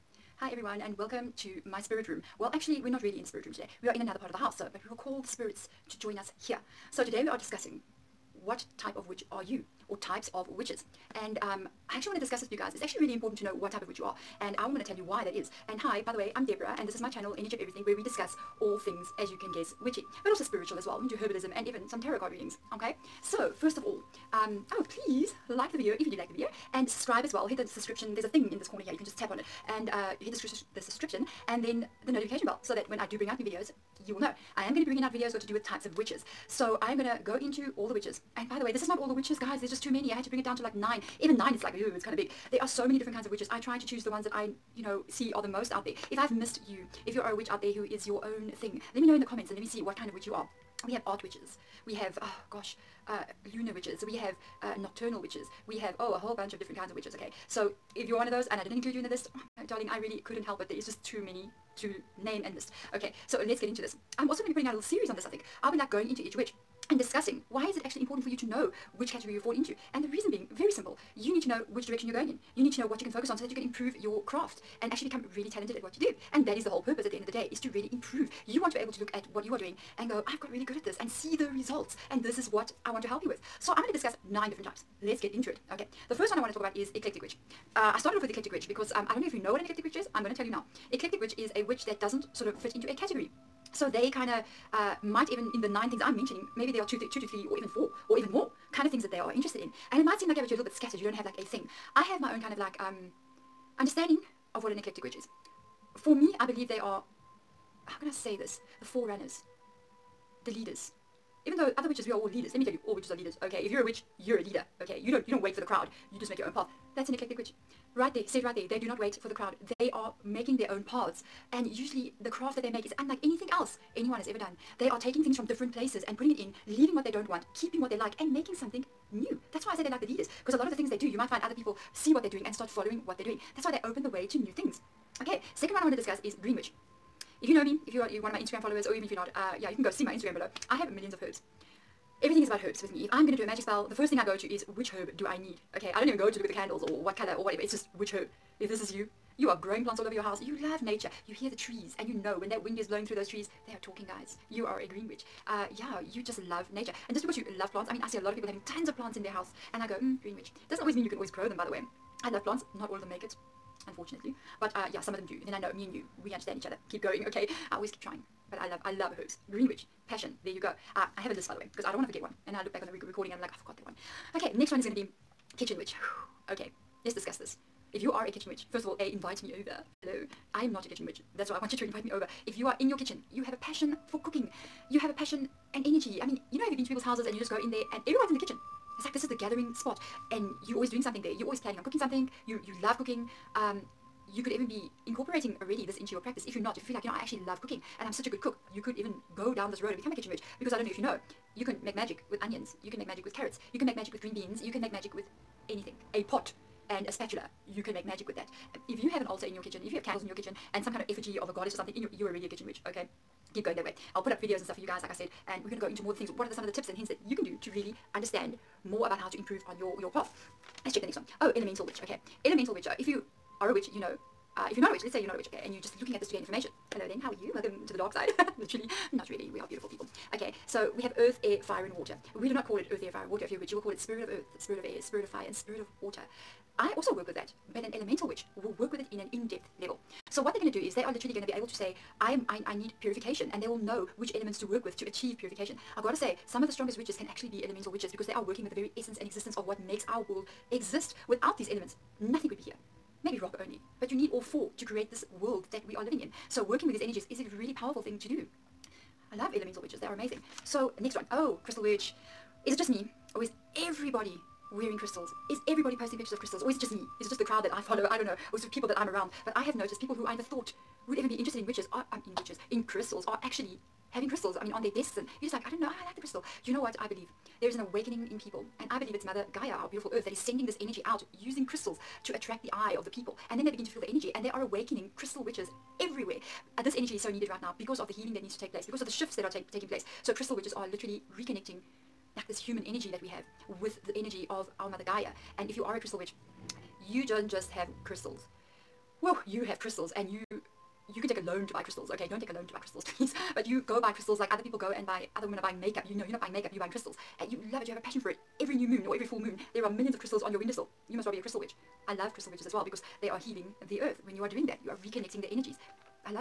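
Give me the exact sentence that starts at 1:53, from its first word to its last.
Okay, if you're a witch, you're a leader.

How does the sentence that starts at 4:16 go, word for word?
So working with these energies is a really powerful thing to do.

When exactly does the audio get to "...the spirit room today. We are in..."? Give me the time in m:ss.
0:03.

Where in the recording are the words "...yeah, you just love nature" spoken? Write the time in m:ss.
2:35.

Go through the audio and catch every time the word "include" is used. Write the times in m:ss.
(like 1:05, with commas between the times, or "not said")
0:58.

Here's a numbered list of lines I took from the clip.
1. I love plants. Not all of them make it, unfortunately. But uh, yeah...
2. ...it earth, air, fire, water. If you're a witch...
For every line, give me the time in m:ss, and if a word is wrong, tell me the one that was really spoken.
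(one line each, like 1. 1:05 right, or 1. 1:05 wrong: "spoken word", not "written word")
1. 2:42 right
2. 3:52 right.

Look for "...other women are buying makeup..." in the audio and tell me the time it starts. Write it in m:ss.
5:05.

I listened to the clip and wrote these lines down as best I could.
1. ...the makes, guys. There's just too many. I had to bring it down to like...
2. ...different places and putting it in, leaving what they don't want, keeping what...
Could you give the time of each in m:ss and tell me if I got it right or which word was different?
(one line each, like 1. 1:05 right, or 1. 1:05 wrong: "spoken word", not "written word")
1. 0:39 wrong: "witches", not "makes"
2. 2:05 right.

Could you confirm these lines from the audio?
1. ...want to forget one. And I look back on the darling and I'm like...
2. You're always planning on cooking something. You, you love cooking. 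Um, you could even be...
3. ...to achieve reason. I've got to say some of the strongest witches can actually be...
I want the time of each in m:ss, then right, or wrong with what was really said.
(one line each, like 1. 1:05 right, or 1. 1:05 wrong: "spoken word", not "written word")
1. 2:51 wrong: "recording", not "darling"
2. 3:11 right
3. 4:04 wrong: "purification", not "reason".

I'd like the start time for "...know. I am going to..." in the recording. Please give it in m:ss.
0:34.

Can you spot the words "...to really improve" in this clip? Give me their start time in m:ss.
1:17.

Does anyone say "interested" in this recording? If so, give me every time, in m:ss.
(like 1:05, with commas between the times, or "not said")
1:39, 4:31.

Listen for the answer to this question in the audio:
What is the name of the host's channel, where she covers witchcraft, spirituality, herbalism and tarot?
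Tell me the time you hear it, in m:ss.
0:17.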